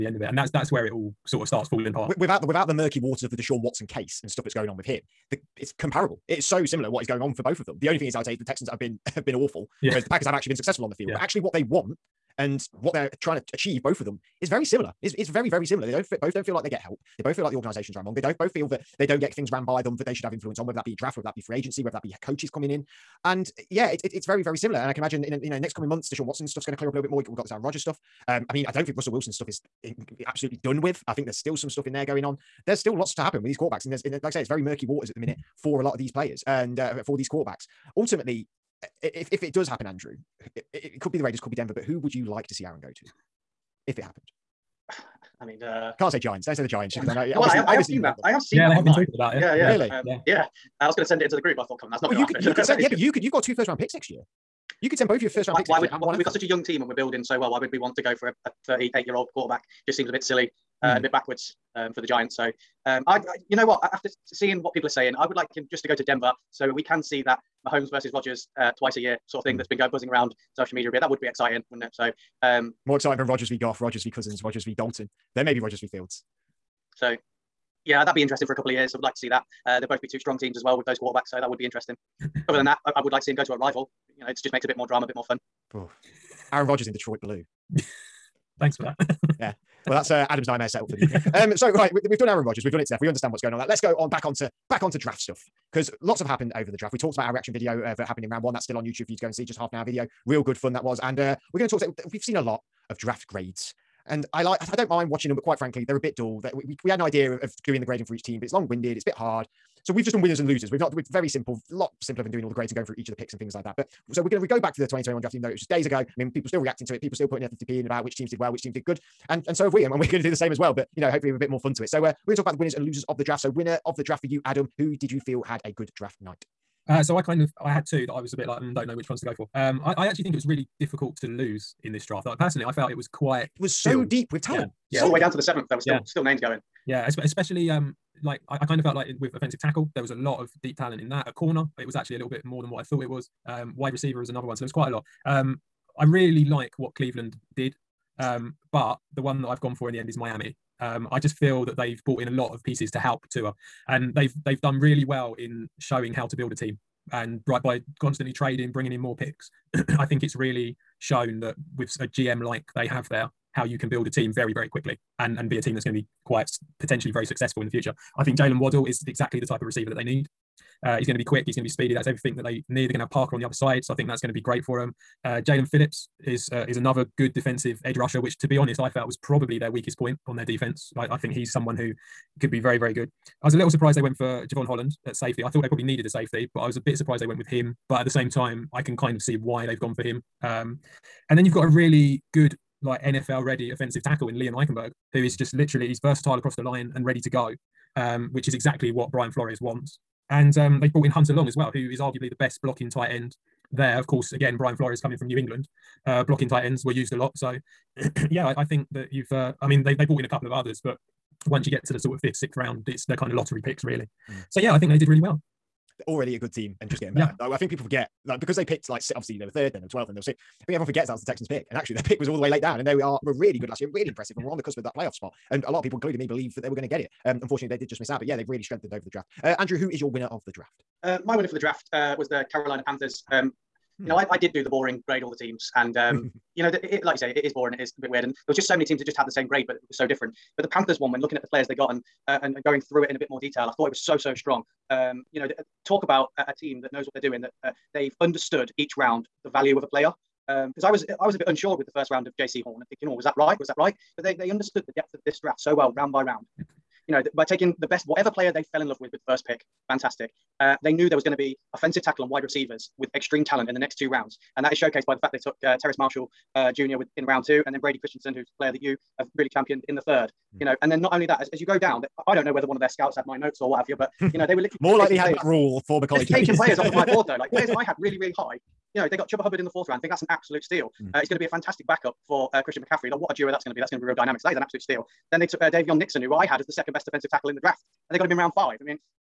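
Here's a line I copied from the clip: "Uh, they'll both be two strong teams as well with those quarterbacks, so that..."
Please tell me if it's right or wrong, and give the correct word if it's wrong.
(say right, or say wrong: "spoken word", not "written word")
right.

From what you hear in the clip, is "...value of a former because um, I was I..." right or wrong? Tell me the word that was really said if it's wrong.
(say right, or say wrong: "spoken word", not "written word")
wrong: "player", not "former".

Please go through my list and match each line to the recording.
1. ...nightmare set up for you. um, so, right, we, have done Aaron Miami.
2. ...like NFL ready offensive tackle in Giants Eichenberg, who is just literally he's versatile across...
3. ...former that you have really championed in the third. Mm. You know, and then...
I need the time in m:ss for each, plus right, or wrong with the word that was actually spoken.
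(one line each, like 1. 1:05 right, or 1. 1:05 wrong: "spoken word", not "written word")
1. 1:30 wrong: "Rodgers", not "Miami"
2. 3:12 wrong: "Liam", not "Giants"
3. 4:28 wrong: "player", not "former".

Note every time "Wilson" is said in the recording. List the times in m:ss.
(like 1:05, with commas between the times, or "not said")
0:29.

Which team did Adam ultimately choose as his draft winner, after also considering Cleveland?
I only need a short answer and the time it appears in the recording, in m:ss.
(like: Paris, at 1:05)
Miami, at 2:30.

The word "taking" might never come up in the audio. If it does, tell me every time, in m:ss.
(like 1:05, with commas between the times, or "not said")
4:17, 4:36.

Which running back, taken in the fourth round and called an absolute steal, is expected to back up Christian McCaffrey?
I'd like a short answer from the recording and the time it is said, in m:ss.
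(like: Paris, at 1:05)
Chuba Hubbard, at 4:39.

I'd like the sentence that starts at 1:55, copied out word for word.
I mean, people still reacting to it, people still putting their 50p in about which teams did well, which teams did good.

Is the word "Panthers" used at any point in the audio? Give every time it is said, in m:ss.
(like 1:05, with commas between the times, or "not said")
3:52, 4:00.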